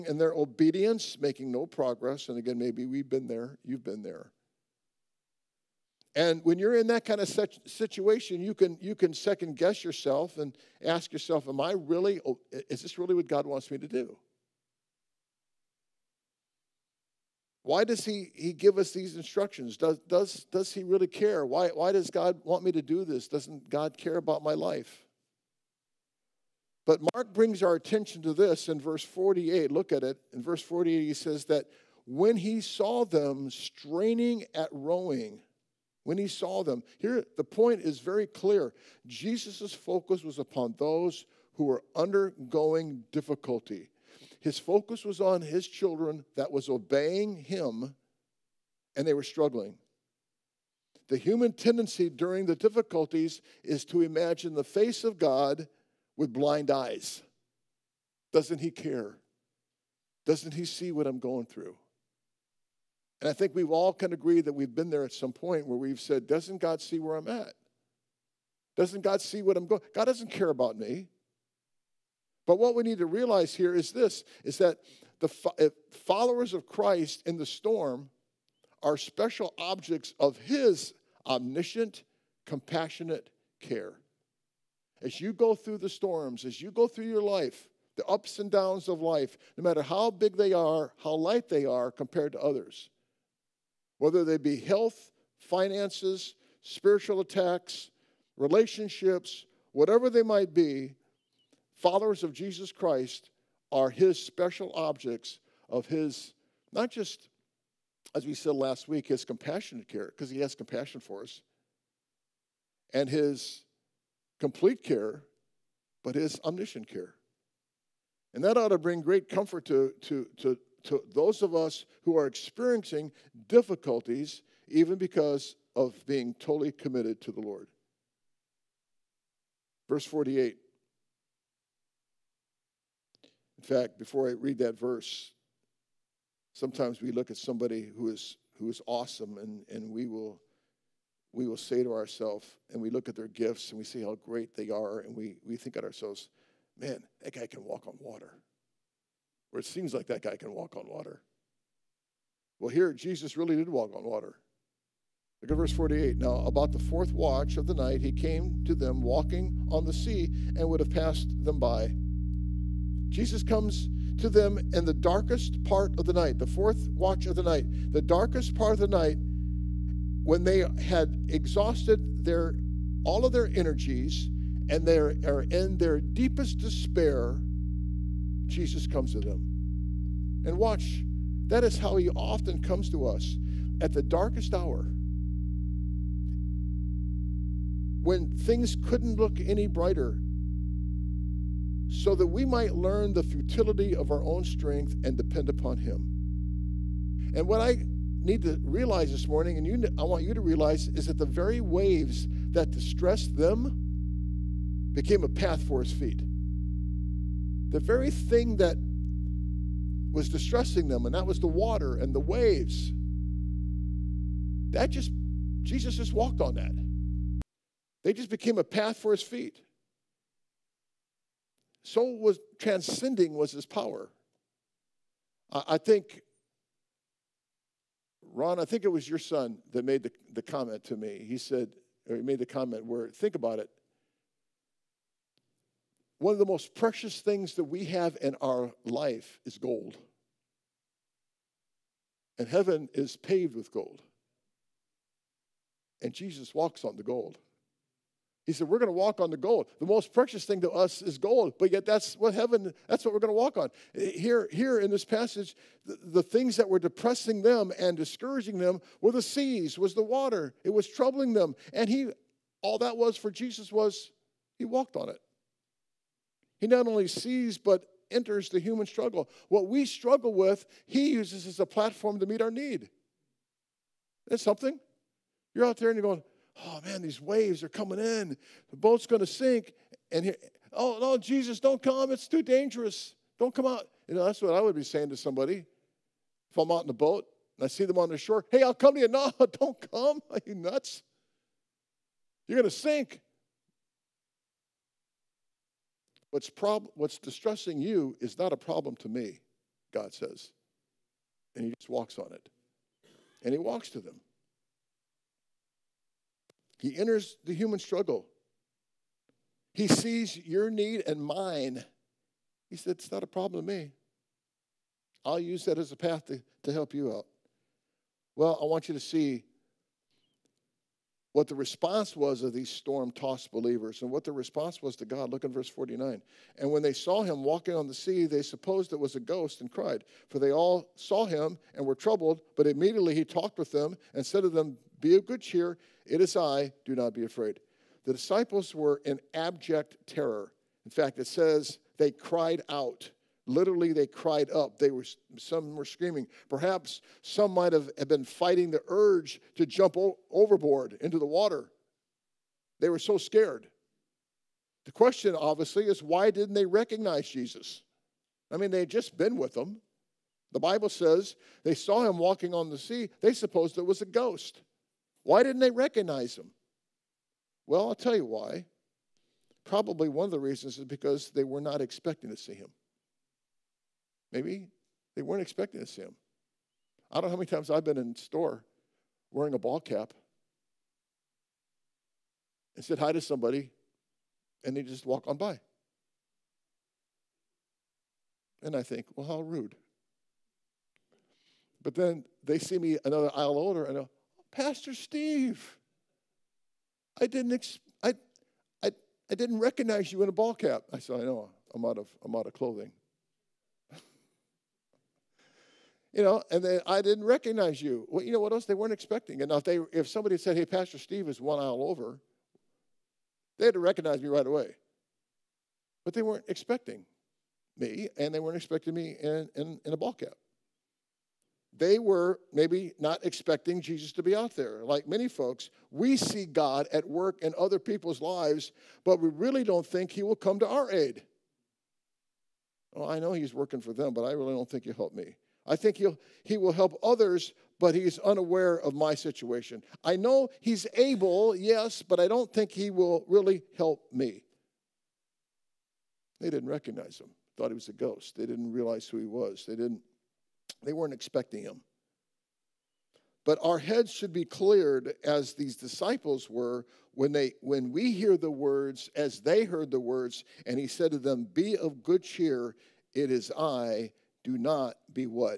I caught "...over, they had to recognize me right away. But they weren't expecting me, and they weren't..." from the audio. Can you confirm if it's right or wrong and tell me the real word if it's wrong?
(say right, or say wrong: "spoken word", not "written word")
right.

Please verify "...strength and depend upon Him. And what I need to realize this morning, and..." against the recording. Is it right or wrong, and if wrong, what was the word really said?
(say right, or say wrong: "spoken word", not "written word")
right.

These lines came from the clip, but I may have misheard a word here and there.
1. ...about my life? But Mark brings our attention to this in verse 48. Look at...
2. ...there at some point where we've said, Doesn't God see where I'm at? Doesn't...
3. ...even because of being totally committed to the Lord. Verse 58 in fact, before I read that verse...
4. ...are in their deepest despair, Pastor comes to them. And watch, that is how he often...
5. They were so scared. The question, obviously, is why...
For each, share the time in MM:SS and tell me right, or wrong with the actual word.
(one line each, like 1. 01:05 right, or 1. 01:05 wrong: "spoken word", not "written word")
1. 00:24 right
2. 01:04 right
3. 02:04 wrong: "48", not "58"
4. 02:54 wrong: "Jesus", not "Pastor"
5. 05:52 right.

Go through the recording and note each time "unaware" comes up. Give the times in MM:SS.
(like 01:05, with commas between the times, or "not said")
07:18.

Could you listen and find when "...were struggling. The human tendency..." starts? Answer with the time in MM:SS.
00:49.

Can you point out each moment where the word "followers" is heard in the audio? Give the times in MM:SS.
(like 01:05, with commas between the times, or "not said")
01:16, 01:41.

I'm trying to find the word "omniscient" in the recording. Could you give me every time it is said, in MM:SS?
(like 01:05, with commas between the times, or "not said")
01:21, 01:56.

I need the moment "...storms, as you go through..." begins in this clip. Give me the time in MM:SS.
01:25.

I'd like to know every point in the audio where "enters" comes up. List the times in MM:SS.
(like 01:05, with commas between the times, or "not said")
04:28, 05:06.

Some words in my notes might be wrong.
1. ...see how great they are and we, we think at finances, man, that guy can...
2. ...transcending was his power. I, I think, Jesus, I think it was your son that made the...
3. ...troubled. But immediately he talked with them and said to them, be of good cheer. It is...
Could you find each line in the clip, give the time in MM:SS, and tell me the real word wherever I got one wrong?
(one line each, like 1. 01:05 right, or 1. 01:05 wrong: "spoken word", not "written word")
1. 02:23 wrong: "ourselves", not "finances"
2. 03:42 wrong: "Ron", not "Jesus"
3. 05:31 right.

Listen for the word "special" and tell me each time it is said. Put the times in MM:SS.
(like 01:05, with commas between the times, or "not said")
01:18, 01:44.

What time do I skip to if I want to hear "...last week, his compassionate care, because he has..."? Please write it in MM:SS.
01:48.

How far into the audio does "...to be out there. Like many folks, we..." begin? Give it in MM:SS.
07:04.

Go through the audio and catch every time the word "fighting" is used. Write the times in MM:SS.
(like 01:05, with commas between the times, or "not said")
05:48.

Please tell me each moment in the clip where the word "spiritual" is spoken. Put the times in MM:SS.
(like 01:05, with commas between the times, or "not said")
01:36.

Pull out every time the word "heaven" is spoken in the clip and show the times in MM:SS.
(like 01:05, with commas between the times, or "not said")
04:02, 04:12.